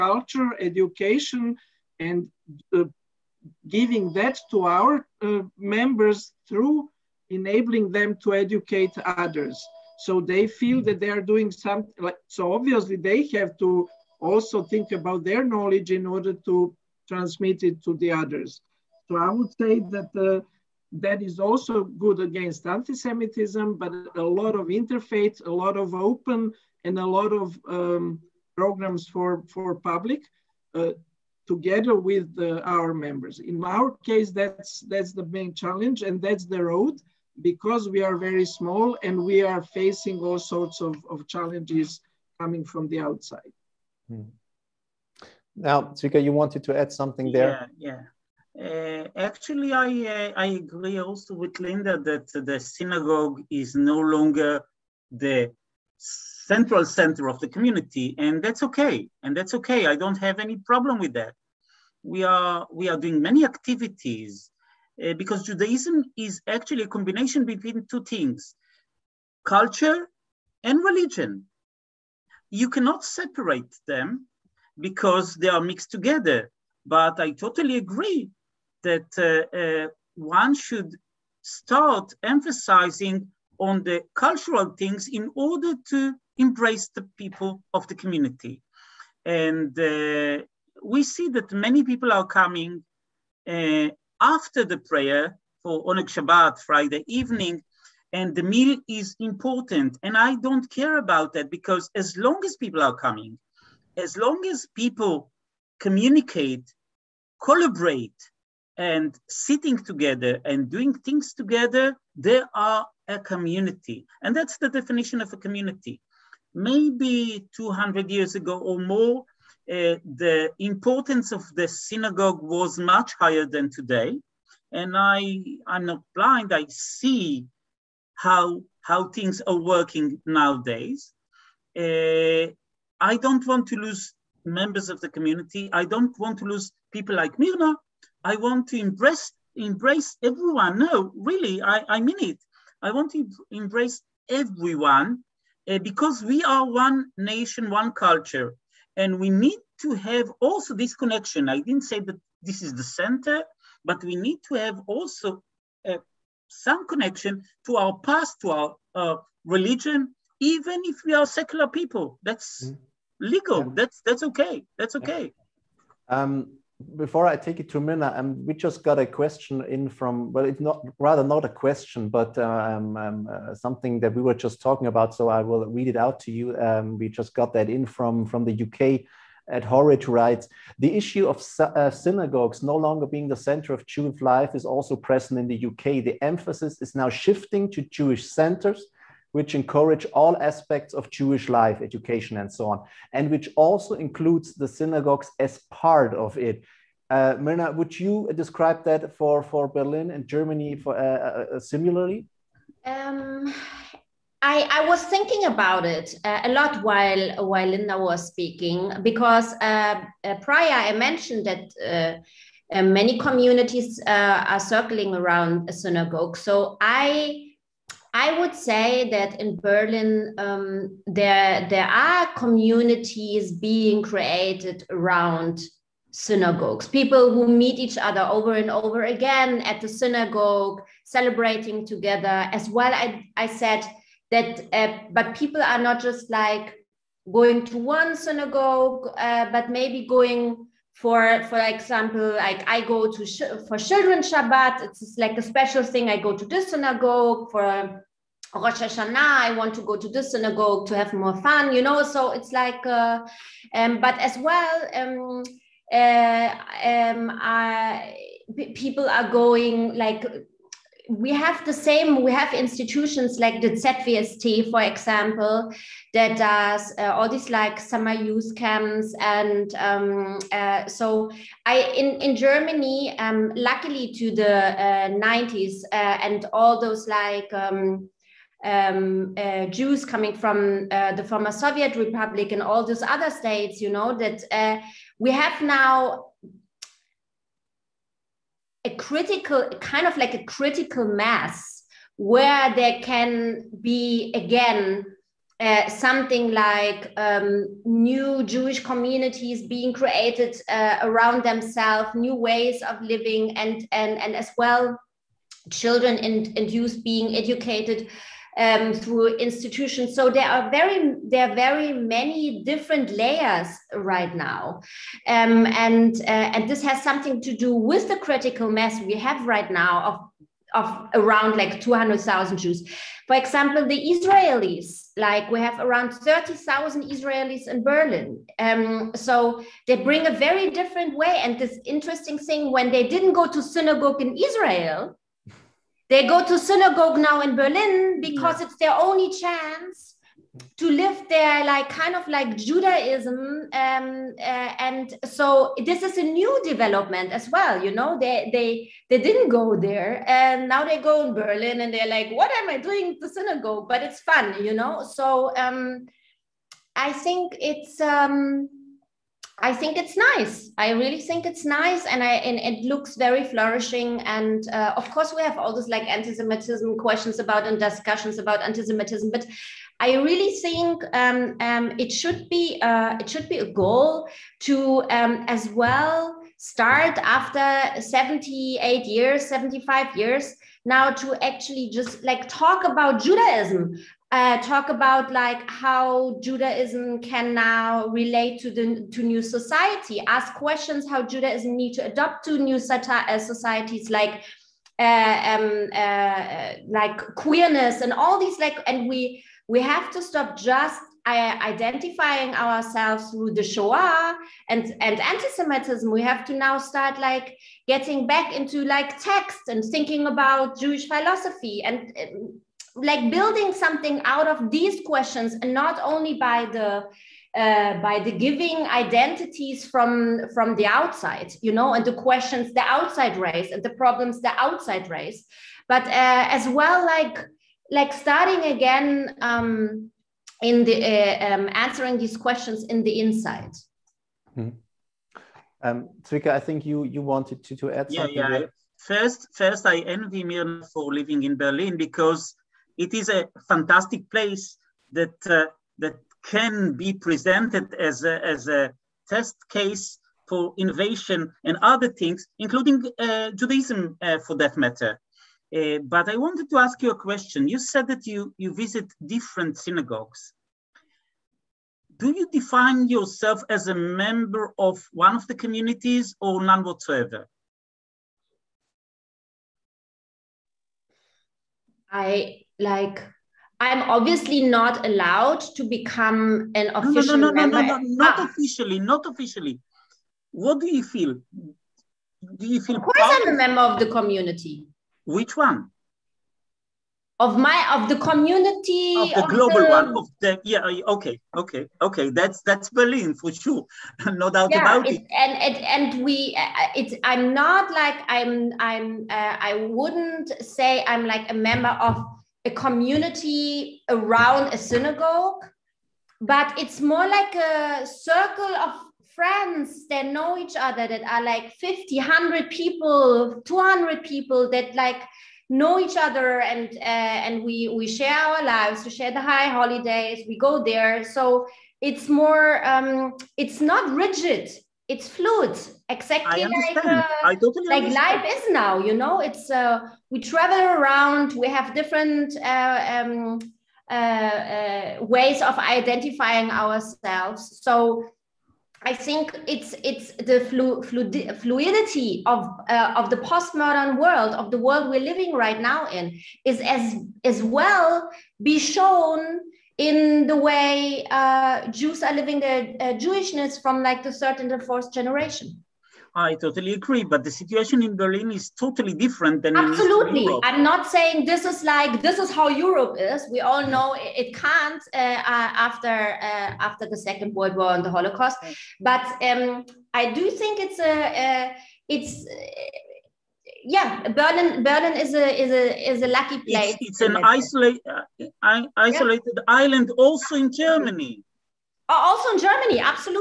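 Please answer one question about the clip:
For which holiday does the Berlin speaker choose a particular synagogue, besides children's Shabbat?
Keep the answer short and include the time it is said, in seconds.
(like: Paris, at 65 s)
Rosh Hashanah, at 248 s.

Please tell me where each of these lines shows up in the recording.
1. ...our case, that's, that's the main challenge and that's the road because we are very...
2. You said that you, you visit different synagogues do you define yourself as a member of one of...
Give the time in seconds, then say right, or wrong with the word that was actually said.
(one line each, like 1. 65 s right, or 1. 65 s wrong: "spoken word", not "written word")
1. 33 s right
2. 457 s right.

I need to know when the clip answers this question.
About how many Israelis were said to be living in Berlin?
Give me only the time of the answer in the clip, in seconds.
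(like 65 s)
326 s.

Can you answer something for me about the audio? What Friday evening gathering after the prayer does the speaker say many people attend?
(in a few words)
Oneg Shabbat.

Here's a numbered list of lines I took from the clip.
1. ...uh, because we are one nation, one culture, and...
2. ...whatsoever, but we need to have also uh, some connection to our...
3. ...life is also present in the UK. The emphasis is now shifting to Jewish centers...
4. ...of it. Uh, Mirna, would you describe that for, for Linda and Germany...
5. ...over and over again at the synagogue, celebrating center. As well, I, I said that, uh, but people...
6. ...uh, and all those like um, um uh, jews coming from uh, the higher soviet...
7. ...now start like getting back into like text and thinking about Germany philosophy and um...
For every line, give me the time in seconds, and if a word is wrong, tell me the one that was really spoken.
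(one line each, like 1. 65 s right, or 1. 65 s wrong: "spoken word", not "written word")
1. 145 s right
2. 152 s wrong: "center", not "whatsoever"
3. 184 s right
4. 196 s wrong: "Berlin", not "Linda"
5. 228 s wrong: "together", not "center"
6. 275 s wrong: "former", not "higher"
7. 406 s wrong: "Jewish", not "Germany".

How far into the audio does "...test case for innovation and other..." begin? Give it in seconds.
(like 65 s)
449 s.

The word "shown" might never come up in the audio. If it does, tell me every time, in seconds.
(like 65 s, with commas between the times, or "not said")
548 s.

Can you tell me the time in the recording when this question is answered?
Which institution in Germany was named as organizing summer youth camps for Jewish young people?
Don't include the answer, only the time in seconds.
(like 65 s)
263 s.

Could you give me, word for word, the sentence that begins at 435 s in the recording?
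Um, Zvika, I think you you wanted to, to add yeah, something.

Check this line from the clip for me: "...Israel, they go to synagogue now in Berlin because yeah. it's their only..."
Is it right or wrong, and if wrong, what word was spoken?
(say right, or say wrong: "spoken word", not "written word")
right.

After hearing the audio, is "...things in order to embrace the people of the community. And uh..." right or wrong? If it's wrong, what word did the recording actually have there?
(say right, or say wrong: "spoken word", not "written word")
right.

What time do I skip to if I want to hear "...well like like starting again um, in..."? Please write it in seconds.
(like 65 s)
426 s.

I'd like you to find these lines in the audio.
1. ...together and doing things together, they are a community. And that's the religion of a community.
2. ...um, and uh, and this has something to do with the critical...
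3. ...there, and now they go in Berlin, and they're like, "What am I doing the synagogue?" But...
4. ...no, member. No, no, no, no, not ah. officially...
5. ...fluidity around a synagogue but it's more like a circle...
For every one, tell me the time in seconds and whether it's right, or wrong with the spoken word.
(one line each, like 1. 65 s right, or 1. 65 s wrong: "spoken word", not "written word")
1. 109 s wrong: "definition", not "religion"
2. 315 s right
3. 349 s right
4. 477 s right
5. 502 s wrong: "community", not "fluidity".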